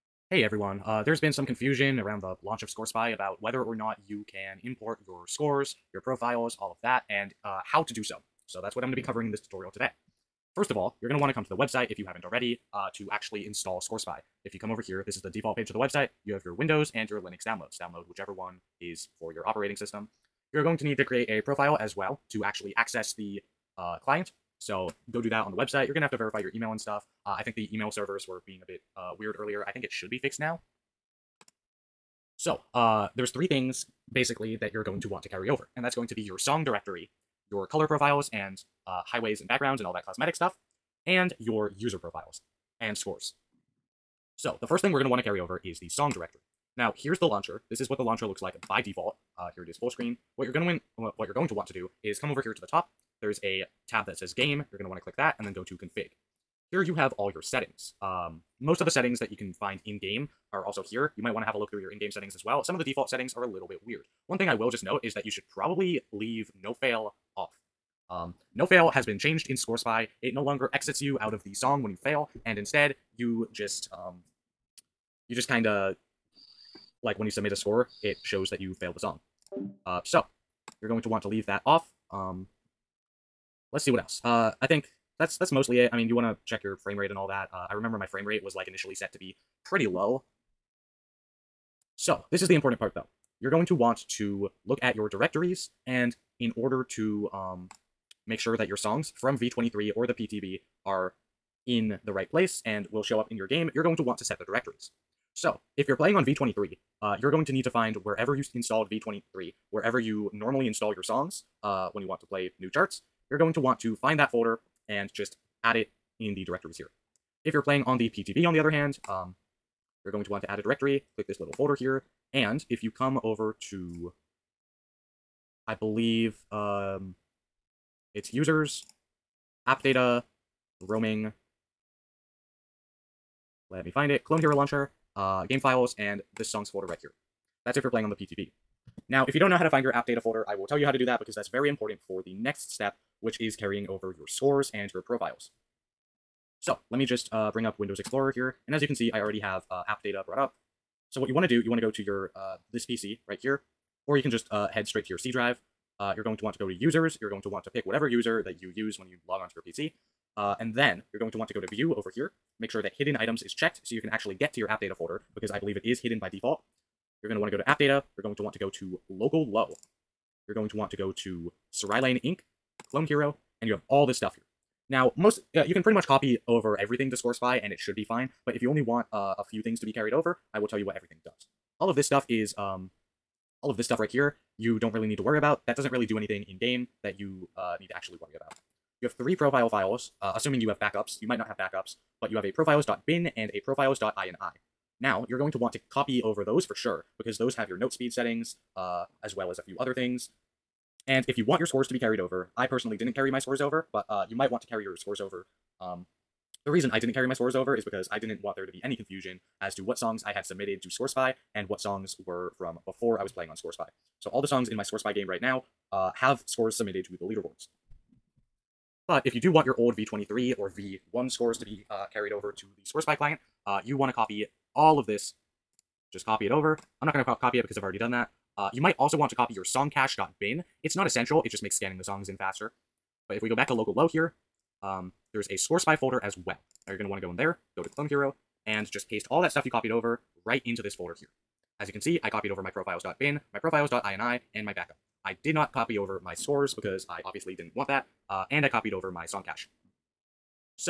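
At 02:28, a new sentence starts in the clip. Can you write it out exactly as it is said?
And as you can see, I already have uh, app data brought up.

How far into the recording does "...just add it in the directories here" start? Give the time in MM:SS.
01:55.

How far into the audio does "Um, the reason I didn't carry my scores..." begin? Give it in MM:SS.
03:25.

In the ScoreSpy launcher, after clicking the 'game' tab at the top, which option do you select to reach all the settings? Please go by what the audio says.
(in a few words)
config.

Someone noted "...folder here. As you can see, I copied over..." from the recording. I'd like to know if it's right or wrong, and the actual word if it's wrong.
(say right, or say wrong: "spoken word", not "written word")
right.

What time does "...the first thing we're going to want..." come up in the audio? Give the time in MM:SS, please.
00:44.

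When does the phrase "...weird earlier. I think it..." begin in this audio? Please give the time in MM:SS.
00:29.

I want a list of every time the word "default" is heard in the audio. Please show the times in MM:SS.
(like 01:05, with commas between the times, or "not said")
00:15, 00:48, 01:02, 02:46.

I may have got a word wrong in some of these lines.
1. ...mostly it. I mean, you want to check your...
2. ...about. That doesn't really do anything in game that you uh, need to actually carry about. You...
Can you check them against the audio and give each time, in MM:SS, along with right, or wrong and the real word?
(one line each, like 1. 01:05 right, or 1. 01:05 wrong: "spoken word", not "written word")
1. 01:25 right
2. 03:05 wrong: "worry", not "carry".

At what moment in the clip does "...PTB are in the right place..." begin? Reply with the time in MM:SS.
01:40.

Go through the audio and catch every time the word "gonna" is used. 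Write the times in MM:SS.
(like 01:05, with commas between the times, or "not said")
00:50, 00:54.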